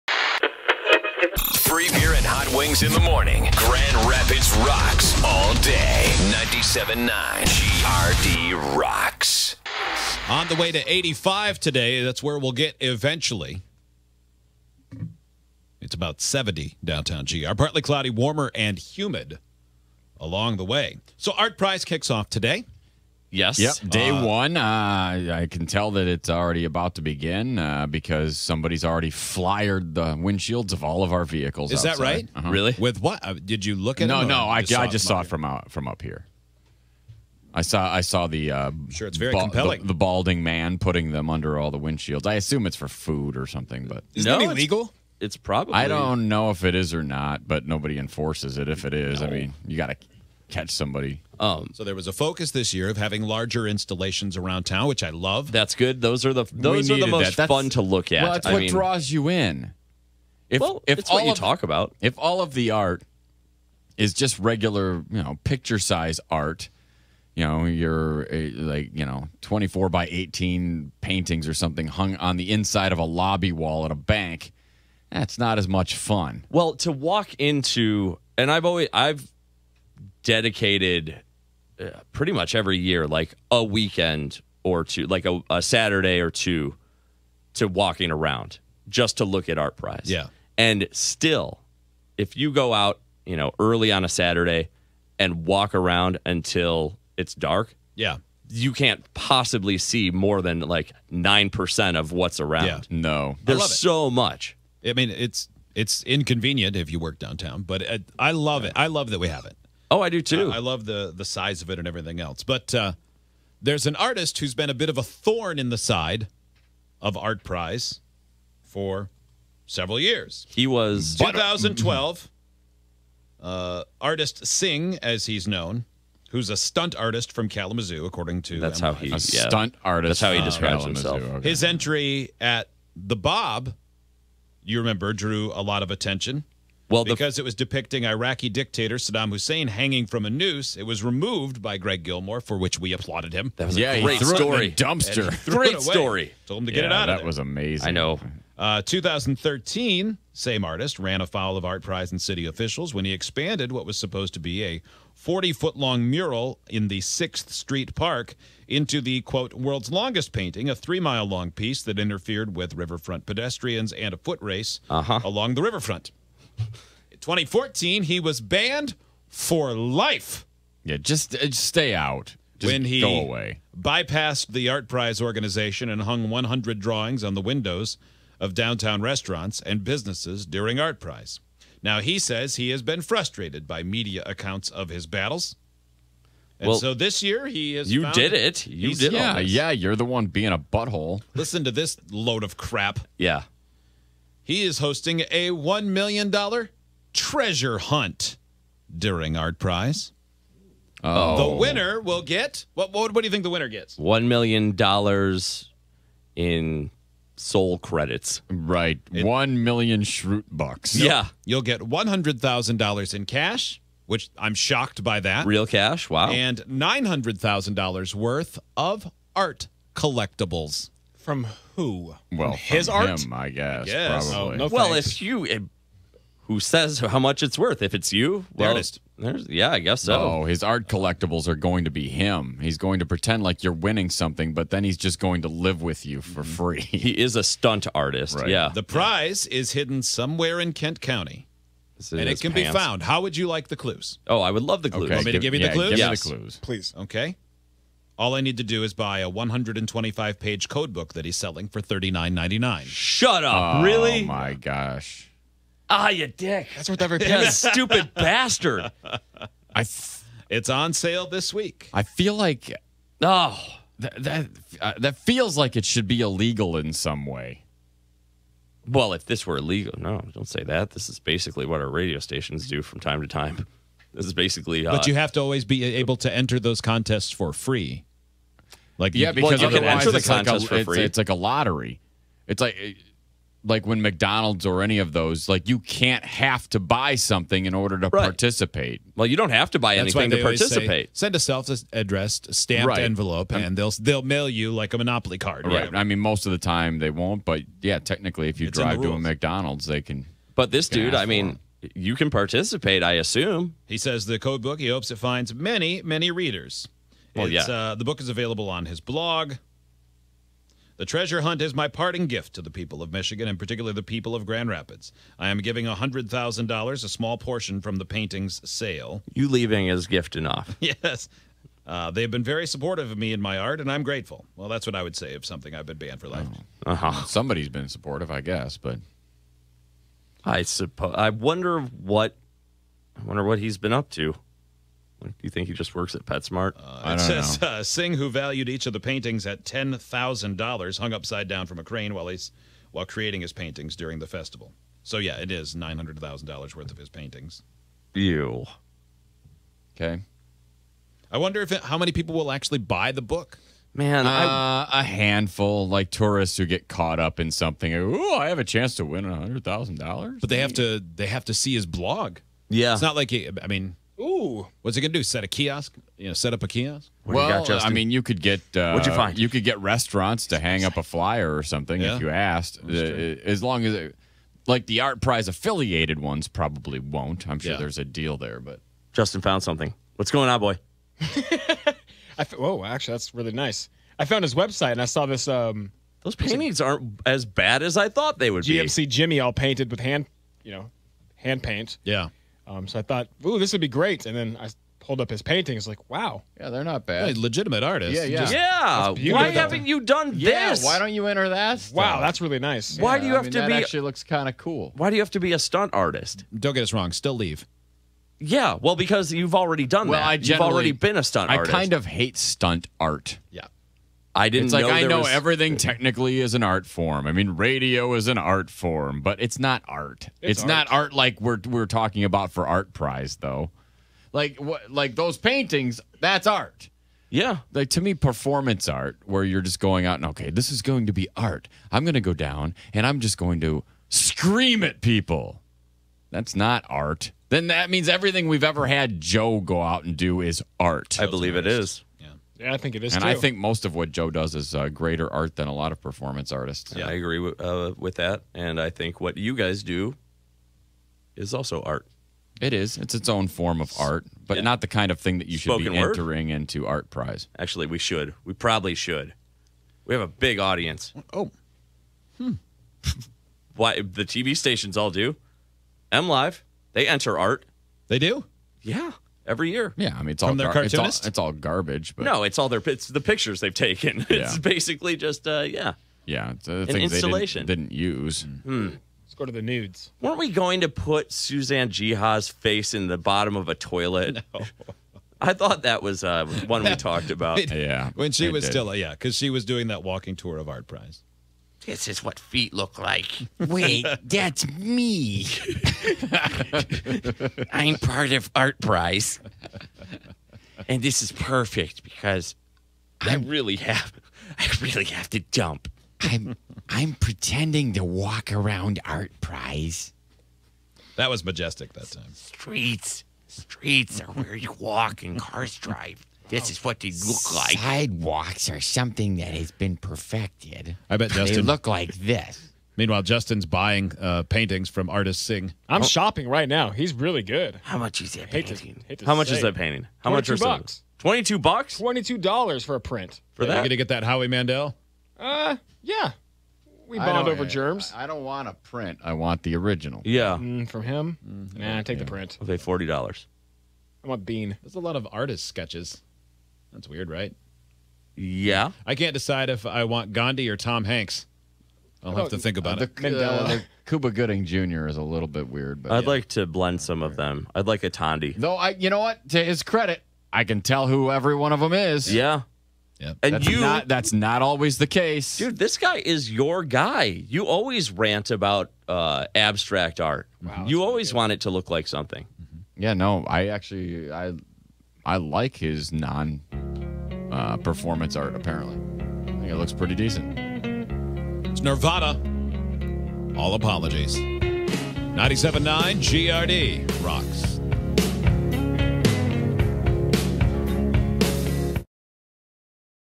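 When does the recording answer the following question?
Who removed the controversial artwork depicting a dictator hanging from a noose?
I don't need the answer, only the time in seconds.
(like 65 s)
141 s.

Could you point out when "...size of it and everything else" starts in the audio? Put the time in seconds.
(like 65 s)
111 s.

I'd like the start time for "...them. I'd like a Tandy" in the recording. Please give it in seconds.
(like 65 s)
557 s.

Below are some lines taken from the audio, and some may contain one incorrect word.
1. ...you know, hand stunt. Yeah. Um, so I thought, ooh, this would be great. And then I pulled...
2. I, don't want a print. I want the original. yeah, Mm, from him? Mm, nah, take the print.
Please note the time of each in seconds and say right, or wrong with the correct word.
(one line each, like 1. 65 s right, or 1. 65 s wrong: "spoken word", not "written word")
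1. 390 s wrong: "paint", not "stunt"
2. 538 s right.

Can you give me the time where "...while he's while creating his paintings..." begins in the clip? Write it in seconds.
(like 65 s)
342 s.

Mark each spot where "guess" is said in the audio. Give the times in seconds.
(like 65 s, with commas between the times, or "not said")
223 s, 229 s, 328 s.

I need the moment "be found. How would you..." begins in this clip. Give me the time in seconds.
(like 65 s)
242 s.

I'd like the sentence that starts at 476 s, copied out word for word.
Yeah, it's, uh, an installation didn't, didn't, use.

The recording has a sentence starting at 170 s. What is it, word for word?
Yeah, just, uh, just stay out.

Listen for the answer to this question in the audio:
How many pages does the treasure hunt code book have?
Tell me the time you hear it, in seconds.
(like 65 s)
249 s.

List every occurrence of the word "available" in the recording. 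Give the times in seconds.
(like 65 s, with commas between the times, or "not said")
308 s.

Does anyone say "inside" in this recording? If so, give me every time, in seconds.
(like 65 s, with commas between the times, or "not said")
72 s.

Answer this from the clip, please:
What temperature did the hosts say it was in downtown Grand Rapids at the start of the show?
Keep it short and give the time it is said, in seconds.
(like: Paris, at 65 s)
70, at 16 s.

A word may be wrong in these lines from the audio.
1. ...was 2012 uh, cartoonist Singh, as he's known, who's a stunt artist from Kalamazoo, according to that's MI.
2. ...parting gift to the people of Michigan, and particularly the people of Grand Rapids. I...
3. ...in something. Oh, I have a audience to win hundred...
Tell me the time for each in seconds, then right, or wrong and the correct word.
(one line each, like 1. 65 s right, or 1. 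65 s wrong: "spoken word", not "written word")
1. 120 s wrong: "artist", not "cartoonist"
2. 311 s right
3. 357 s wrong: "chance", not "audience".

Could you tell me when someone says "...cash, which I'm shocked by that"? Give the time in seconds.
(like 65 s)
213 s.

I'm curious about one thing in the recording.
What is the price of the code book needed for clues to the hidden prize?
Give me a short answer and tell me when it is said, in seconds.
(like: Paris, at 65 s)
$39.99, at 251 s.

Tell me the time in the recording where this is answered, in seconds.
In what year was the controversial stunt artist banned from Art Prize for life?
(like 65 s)
167 s.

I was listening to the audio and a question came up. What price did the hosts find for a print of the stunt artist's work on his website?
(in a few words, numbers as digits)
$22.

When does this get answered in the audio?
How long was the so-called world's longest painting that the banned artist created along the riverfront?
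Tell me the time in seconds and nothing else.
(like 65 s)
160 s.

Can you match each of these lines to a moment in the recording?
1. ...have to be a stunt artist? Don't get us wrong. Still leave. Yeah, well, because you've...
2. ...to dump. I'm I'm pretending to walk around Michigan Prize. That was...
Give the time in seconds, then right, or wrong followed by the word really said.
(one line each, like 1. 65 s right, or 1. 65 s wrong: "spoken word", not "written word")
1. 405 s right
2. 505 s wrong: "Art", not "Michigan".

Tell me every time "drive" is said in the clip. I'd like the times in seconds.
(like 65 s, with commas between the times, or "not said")
298 s, 515 s.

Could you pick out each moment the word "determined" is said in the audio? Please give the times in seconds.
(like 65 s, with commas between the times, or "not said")
not said.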